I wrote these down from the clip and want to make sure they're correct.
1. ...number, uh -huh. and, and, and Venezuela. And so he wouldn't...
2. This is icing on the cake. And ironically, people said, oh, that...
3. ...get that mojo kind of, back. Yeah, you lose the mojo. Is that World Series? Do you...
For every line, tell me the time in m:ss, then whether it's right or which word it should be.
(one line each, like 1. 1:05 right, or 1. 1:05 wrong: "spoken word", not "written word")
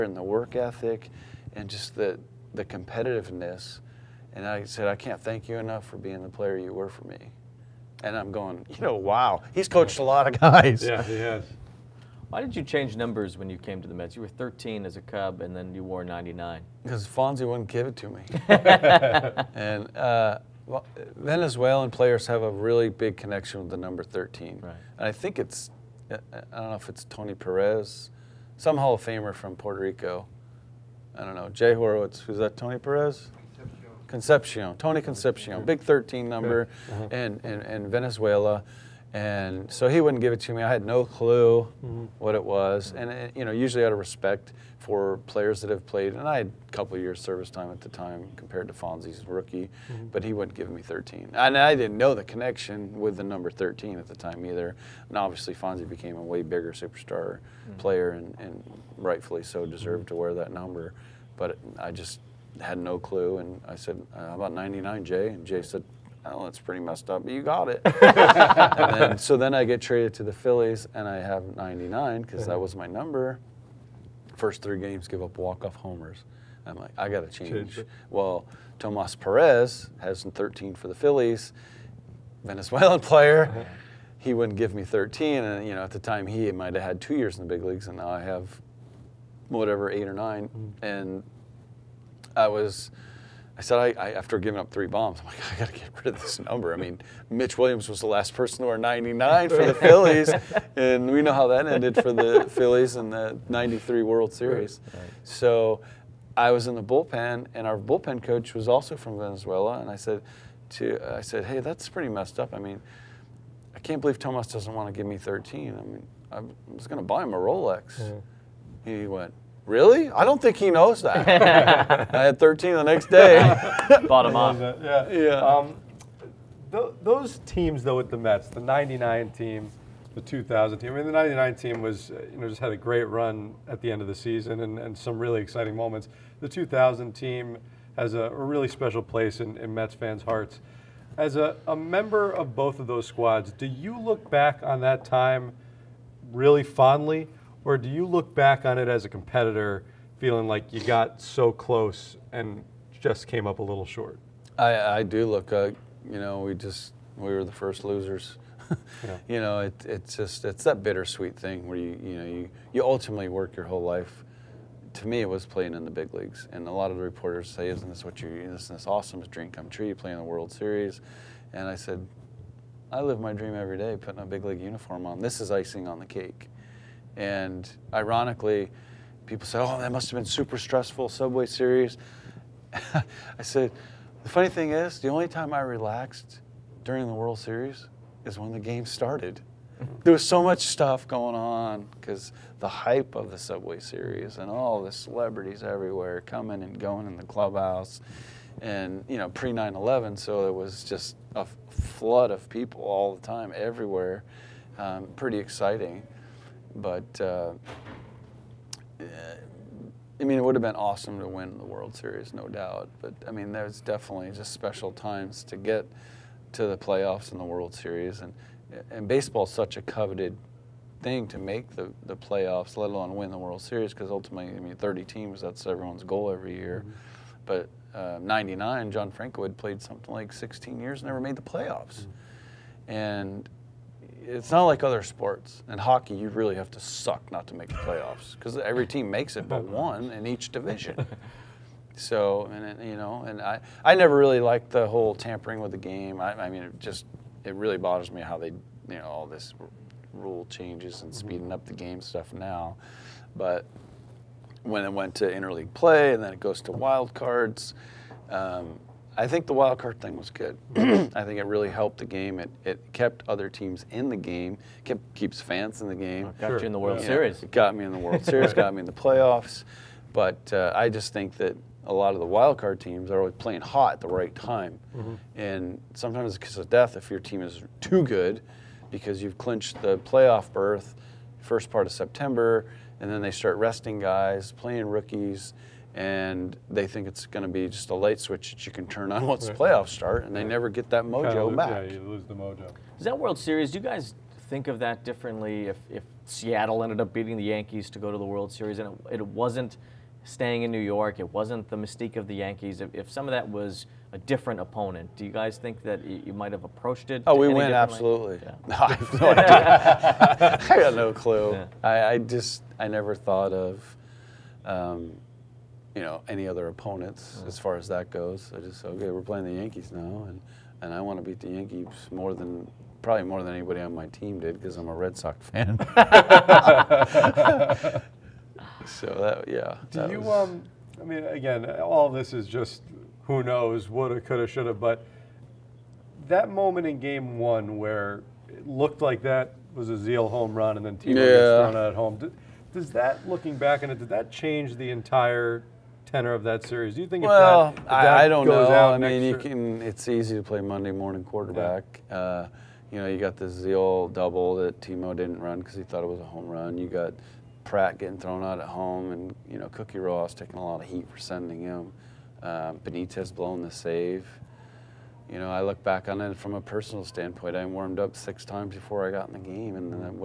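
1. 0:36 right
2. 2:55 right
3. 4:50 right.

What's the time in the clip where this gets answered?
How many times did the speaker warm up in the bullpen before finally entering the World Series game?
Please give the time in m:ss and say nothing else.
6:08.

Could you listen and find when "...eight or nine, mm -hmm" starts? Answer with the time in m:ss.
1:29.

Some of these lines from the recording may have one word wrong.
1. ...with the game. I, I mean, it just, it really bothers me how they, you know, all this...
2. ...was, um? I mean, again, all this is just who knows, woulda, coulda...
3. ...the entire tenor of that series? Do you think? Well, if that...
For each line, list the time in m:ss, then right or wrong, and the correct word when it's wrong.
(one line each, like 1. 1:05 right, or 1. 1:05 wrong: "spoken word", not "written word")
1. 4:05 right
2. 5:30 right
3. 5:44 right.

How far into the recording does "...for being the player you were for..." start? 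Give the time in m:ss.
0:05.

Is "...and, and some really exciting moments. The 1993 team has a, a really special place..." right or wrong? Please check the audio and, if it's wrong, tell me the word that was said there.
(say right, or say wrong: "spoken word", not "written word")
wrong: "2000", not "1993".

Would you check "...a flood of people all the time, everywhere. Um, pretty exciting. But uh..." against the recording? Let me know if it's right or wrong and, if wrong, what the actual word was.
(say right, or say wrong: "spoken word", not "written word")
right.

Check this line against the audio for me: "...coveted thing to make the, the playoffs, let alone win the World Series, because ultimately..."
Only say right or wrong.
right.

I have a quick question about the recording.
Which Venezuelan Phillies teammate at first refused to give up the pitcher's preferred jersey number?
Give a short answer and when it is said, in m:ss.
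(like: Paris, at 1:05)
Tomas Perez, at 1:18.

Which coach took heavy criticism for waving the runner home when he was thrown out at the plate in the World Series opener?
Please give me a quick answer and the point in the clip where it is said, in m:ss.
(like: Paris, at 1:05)
Cookie Rojas, at 5:59.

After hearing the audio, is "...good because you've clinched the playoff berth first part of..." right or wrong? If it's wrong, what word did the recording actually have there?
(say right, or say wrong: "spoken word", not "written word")
right.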